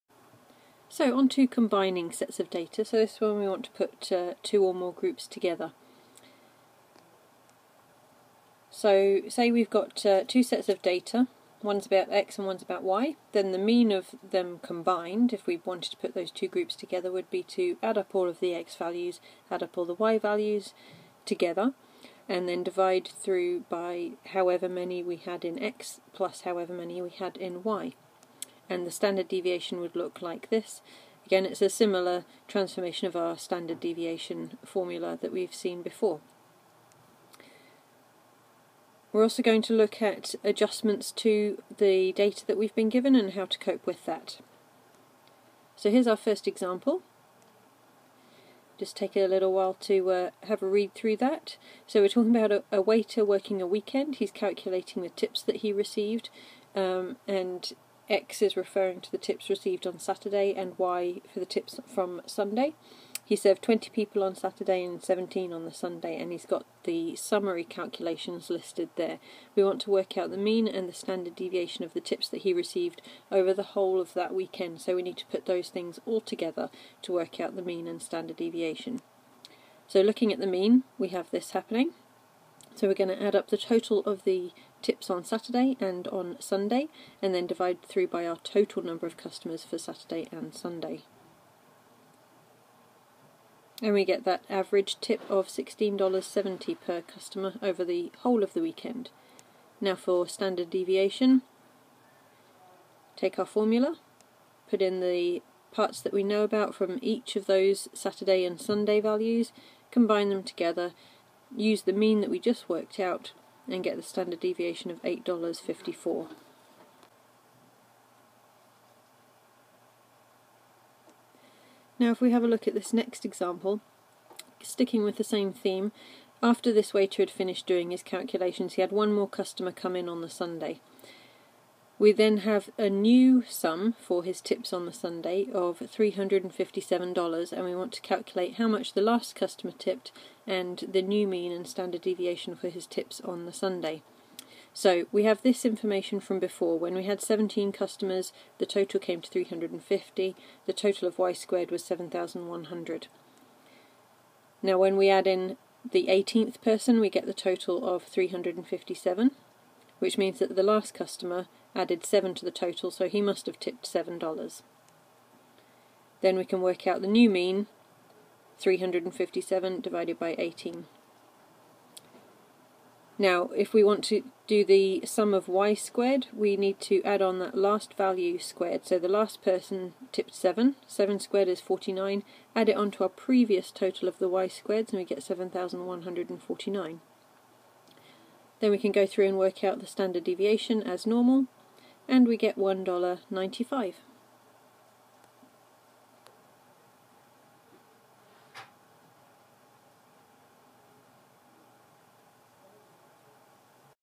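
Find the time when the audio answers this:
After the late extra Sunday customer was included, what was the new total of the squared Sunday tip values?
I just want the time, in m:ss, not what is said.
3:05.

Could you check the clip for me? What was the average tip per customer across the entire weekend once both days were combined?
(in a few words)
$16.70.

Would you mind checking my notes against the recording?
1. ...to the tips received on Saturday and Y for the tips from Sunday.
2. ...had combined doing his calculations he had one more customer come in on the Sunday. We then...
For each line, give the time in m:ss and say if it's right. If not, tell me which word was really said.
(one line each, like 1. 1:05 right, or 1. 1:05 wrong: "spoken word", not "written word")
1. 0:59 right
2. 2:07 wrong: "finished", not "combined".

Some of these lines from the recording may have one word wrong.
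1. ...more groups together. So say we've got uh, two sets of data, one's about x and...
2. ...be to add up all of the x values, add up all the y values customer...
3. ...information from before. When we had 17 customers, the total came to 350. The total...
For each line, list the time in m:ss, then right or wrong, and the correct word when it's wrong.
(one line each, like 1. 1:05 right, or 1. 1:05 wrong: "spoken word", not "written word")
1. 0:04 right
2. 0:17 wrong: "together", not "customer"
3. 2:25 right.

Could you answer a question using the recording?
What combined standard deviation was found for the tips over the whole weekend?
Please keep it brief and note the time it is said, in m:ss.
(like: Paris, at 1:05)
$8.54, at 1:55.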